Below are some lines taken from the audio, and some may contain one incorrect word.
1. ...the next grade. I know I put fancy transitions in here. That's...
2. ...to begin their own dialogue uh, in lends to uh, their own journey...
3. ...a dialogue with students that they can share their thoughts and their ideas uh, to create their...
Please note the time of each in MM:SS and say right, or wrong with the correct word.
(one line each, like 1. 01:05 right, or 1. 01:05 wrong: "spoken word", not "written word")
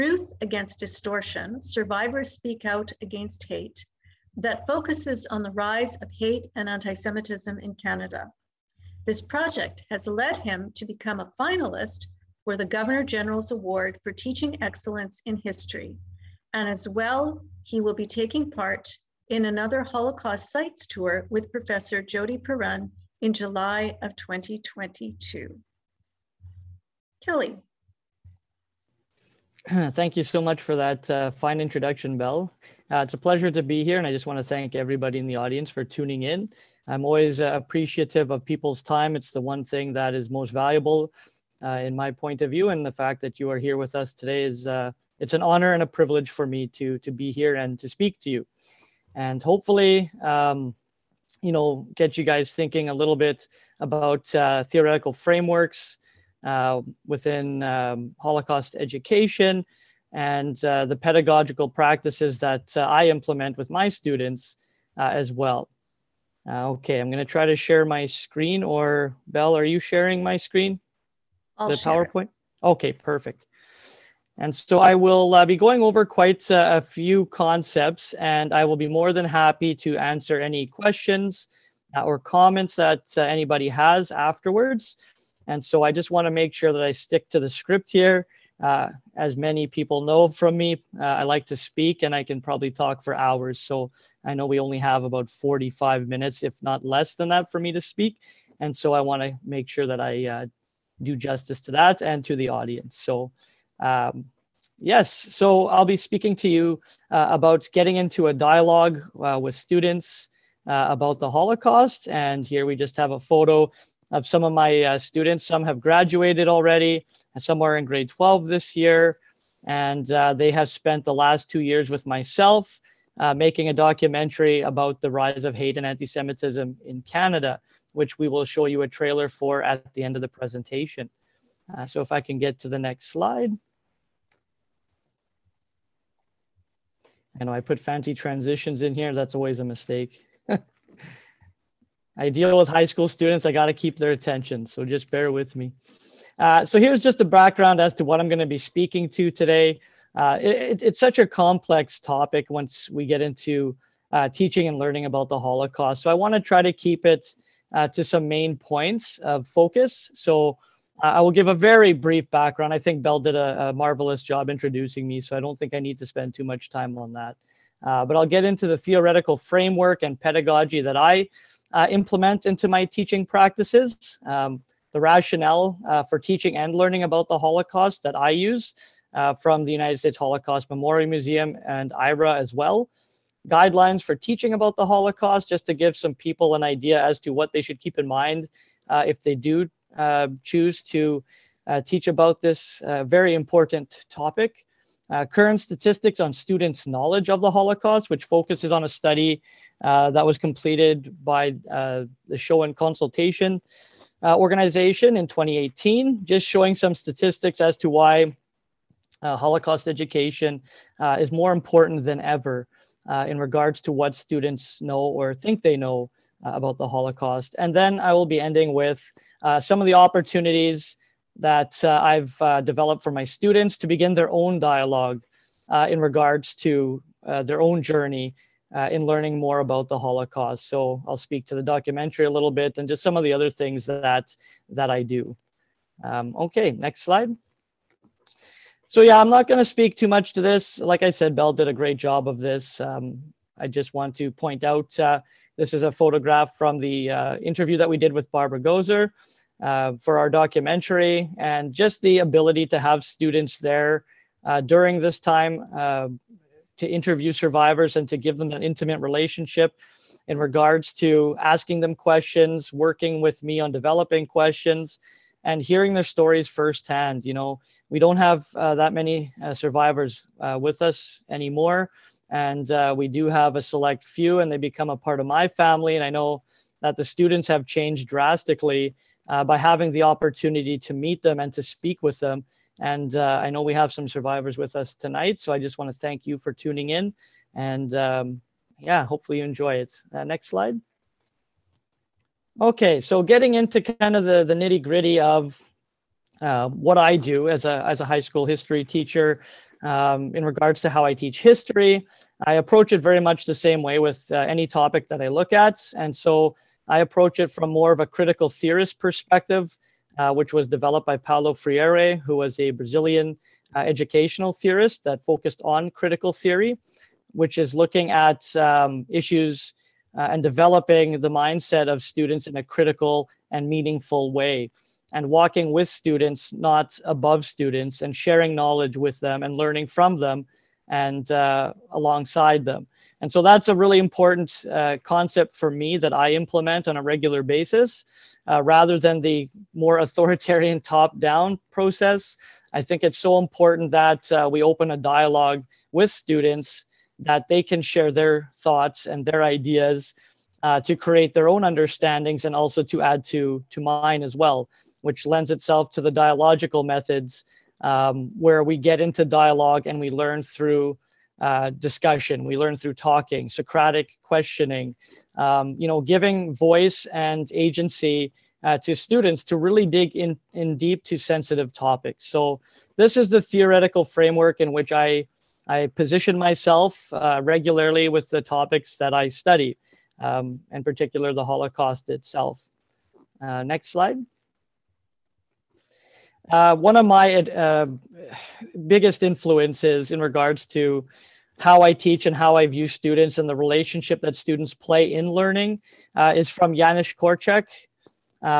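1. 02:12 wrong: "slide", not "grade"
2. 03:43 wrong: "regards", not "lends"
3. 05:44 right.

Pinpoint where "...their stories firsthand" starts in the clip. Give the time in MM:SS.
04:25.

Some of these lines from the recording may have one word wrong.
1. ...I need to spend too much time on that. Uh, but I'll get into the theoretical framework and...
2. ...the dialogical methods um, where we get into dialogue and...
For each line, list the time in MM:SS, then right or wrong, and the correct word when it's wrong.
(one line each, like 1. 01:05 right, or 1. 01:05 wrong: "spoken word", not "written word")
1. 02:45 right
2. 05:56 right.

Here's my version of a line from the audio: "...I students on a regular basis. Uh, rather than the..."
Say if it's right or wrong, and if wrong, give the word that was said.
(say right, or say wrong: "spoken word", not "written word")
wrong: "implement", not "students".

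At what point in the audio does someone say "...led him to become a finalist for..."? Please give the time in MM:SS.
00:10.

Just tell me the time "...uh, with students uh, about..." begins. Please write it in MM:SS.
01:49.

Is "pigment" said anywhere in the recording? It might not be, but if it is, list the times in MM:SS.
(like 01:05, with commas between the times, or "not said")
not said.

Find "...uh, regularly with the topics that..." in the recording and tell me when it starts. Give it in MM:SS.
06:17.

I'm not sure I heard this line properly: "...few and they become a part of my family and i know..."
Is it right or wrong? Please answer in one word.
right.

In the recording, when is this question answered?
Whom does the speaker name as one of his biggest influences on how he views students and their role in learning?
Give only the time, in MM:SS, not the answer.
06:36.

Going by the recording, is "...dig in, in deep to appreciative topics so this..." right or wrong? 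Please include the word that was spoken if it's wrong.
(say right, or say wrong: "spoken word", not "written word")
wrong: "sensitive", not "appreciative".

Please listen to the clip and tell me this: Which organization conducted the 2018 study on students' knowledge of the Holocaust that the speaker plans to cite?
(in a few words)
Schoen Consultation.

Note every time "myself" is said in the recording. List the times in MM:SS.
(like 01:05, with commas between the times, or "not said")
02:02, 06:16.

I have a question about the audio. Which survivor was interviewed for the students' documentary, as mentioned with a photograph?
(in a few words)
Barbara Gozer.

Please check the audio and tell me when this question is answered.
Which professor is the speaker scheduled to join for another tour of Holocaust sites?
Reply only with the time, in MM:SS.
00:22.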